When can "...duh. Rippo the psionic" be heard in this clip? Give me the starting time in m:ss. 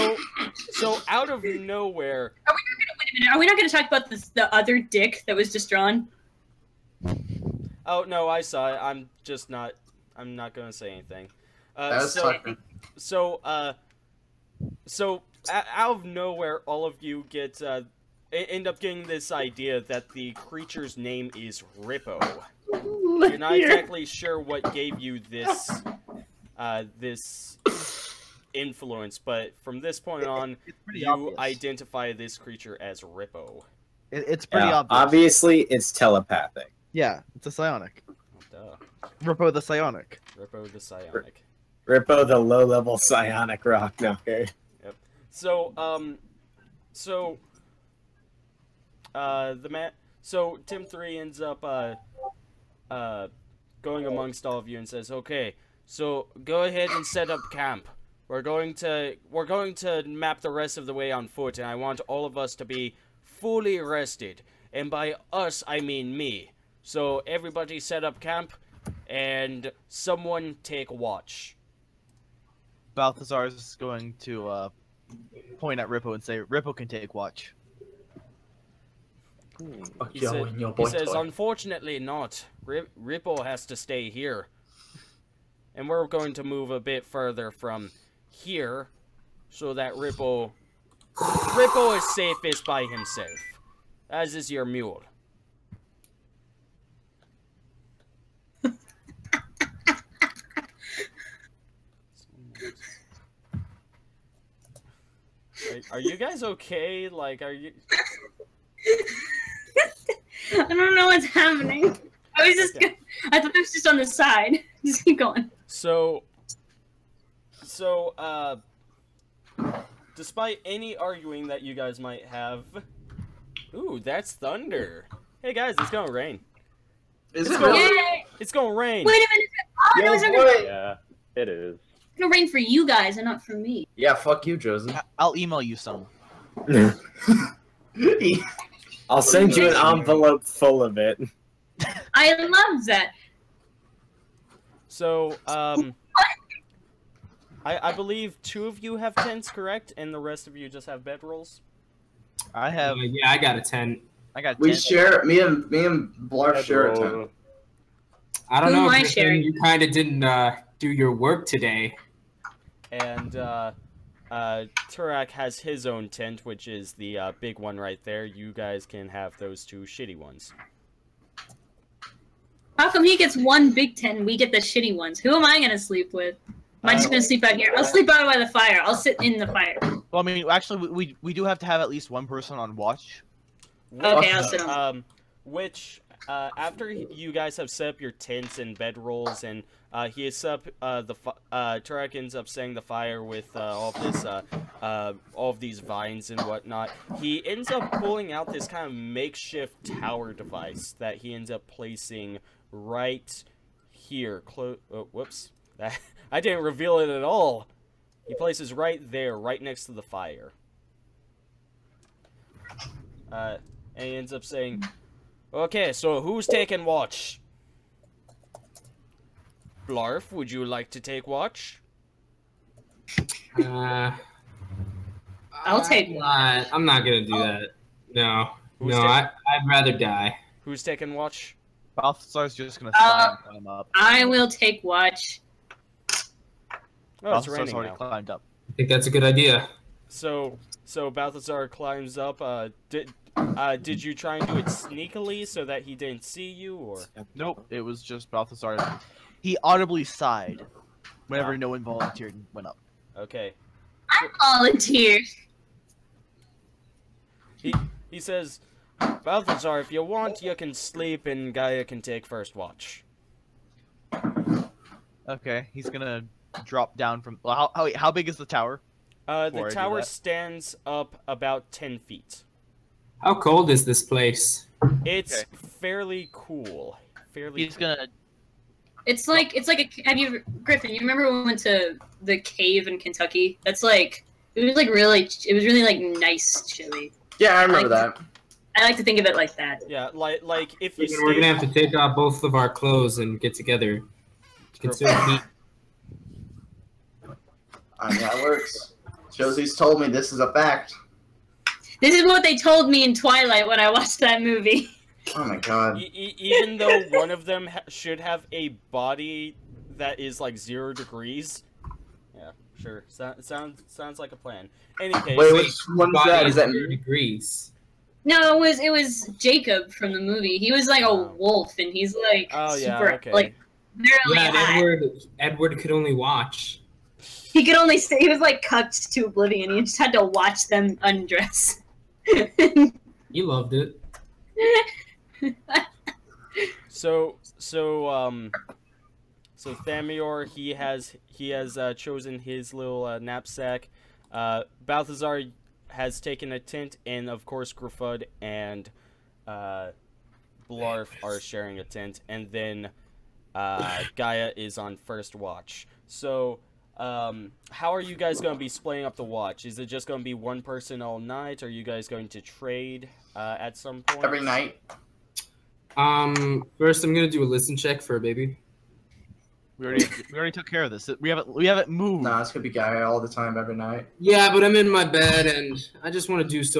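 0:38.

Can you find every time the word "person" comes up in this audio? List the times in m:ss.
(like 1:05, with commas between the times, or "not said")
3:02, 6:00.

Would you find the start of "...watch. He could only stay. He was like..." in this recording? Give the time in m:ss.
5:26.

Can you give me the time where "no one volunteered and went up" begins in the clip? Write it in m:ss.
4:11.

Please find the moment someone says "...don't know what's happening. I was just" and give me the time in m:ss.
1:50.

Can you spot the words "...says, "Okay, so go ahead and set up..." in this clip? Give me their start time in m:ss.
0:54.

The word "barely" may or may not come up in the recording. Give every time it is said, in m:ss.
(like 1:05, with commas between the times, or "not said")
5:23.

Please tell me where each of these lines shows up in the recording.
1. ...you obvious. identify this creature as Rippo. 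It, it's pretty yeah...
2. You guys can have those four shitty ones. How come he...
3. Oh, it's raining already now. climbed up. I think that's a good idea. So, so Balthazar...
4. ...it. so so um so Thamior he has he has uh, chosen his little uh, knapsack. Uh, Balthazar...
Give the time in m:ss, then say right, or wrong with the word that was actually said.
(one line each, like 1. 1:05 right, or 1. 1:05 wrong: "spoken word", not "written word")
1. 0:30 right
2. 2:48 wrong: "two", not "four"
3. 3:57 right
4. 5:33 right.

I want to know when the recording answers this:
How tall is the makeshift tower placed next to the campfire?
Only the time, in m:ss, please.
4:31.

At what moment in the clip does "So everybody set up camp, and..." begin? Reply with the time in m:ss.
1:06.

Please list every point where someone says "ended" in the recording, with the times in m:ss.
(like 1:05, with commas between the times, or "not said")
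not said.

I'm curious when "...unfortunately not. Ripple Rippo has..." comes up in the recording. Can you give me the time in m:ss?
1:21.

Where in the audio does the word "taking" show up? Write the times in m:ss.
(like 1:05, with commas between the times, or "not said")
3:36, 3:50.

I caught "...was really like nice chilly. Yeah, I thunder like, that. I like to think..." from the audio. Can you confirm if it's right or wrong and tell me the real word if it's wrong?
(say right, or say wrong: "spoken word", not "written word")
wrong: "remember", not "thunder".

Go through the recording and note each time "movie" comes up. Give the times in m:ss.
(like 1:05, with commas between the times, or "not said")
5:04, 5:20.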